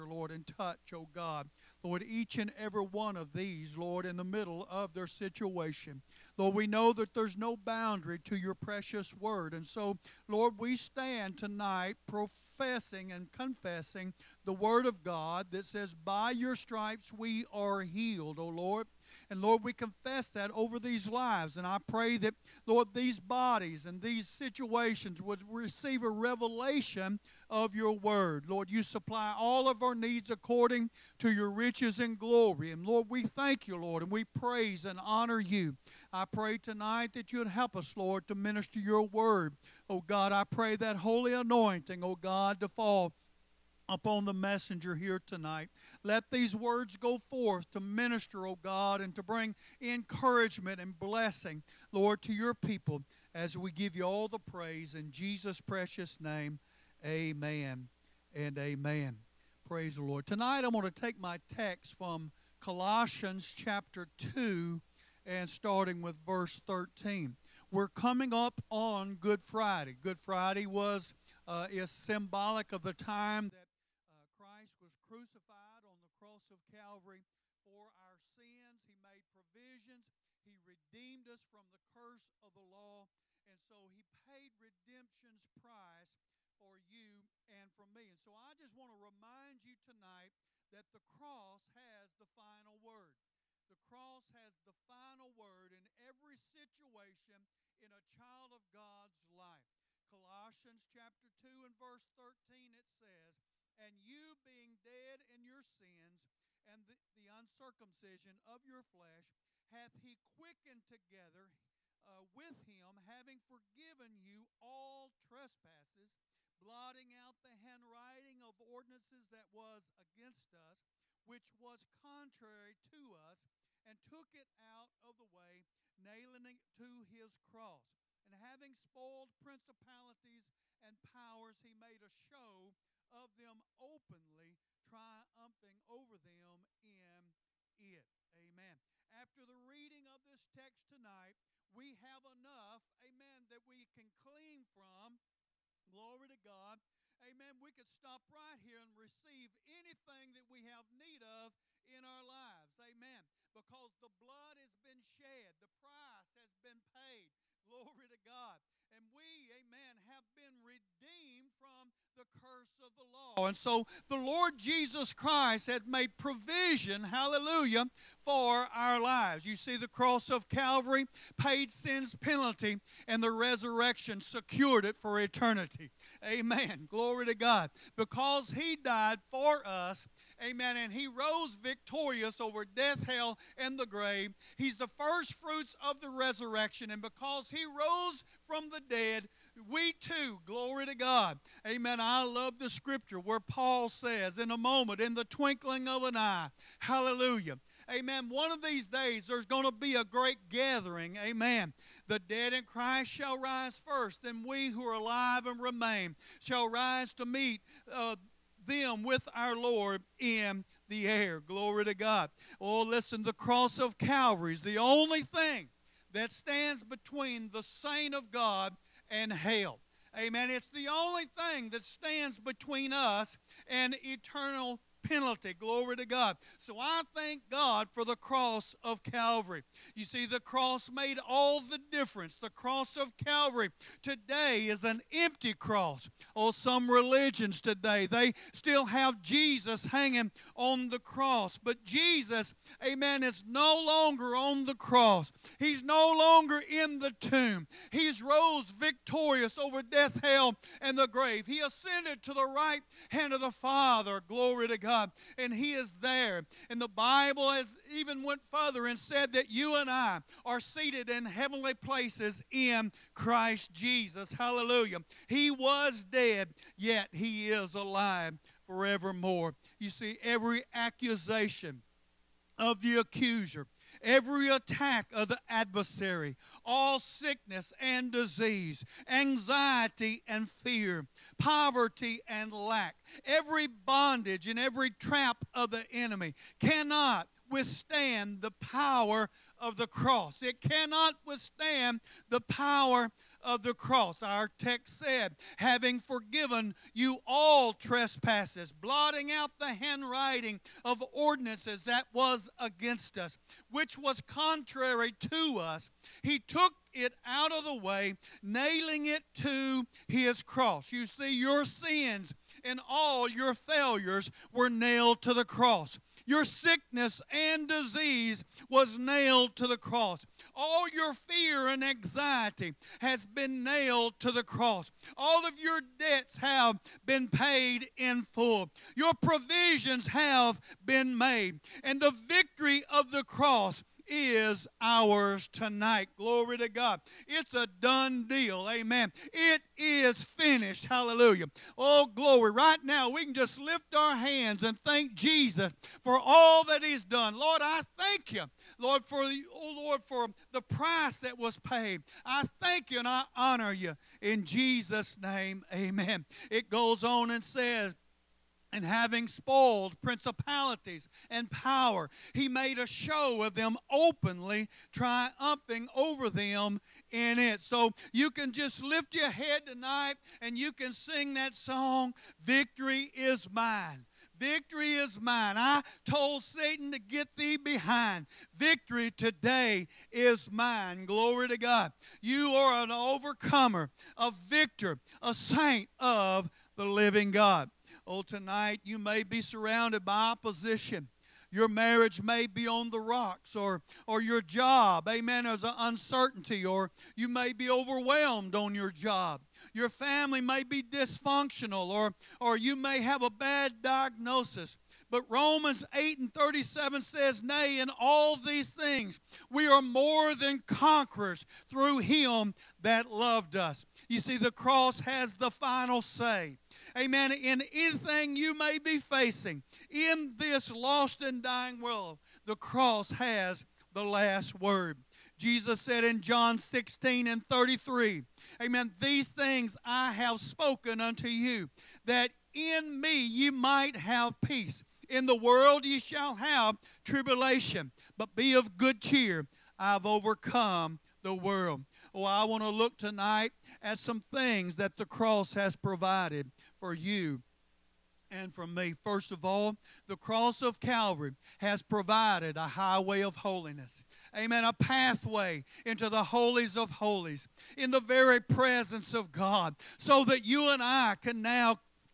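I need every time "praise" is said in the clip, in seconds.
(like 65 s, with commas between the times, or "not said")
34 s, 54 s, 59 s.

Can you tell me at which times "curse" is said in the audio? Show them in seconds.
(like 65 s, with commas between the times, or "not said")
81 s, 162 s.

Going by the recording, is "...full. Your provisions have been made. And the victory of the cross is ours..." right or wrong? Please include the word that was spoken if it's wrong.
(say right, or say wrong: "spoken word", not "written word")
right.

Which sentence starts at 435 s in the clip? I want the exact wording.
In the world you shall have tribulation, but be of good cheer.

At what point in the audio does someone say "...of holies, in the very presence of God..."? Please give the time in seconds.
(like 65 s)
456 s.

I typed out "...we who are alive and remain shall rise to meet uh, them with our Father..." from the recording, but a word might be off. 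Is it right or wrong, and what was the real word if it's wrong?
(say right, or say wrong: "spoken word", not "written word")
wrong: "Lord", not "Father".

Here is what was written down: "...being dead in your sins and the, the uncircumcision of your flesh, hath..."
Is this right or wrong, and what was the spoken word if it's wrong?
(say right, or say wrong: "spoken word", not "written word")
right.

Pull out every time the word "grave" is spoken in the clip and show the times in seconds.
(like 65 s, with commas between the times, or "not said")
183 s, 251 s.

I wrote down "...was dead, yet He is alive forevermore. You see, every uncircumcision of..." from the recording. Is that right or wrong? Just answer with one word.
wrong.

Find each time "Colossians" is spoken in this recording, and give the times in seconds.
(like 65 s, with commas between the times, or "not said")
62 s, 100 s.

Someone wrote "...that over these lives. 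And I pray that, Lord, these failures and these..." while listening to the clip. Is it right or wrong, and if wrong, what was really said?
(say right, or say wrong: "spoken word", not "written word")
wrong: "bodies", not "failures".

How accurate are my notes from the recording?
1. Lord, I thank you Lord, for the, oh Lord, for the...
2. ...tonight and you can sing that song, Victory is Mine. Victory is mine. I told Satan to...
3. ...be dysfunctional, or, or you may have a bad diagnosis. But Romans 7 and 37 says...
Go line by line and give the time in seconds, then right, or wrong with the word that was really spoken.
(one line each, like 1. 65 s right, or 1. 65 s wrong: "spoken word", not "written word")
1. 347 s right
2. 369 s right
3. 400 s wrong: "8", not "7".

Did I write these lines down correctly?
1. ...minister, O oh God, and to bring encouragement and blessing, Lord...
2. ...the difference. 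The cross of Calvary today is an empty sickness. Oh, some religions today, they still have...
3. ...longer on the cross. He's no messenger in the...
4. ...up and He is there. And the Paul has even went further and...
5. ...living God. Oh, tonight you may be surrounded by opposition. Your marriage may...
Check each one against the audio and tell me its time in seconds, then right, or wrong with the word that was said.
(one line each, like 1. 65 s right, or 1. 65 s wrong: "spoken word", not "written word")
1. 47 s right
2. 231 s wrong: "cross", not "sickness"
3. 243 s wrong: "longer", not "messenger"
4. 254 s wrong: "Bible", not "Paul"
5. 386 s right.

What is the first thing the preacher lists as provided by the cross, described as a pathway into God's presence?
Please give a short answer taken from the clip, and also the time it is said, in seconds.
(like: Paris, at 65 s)
a highway of holiness, at 452 s.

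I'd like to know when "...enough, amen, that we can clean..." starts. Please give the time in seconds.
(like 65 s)
142 s.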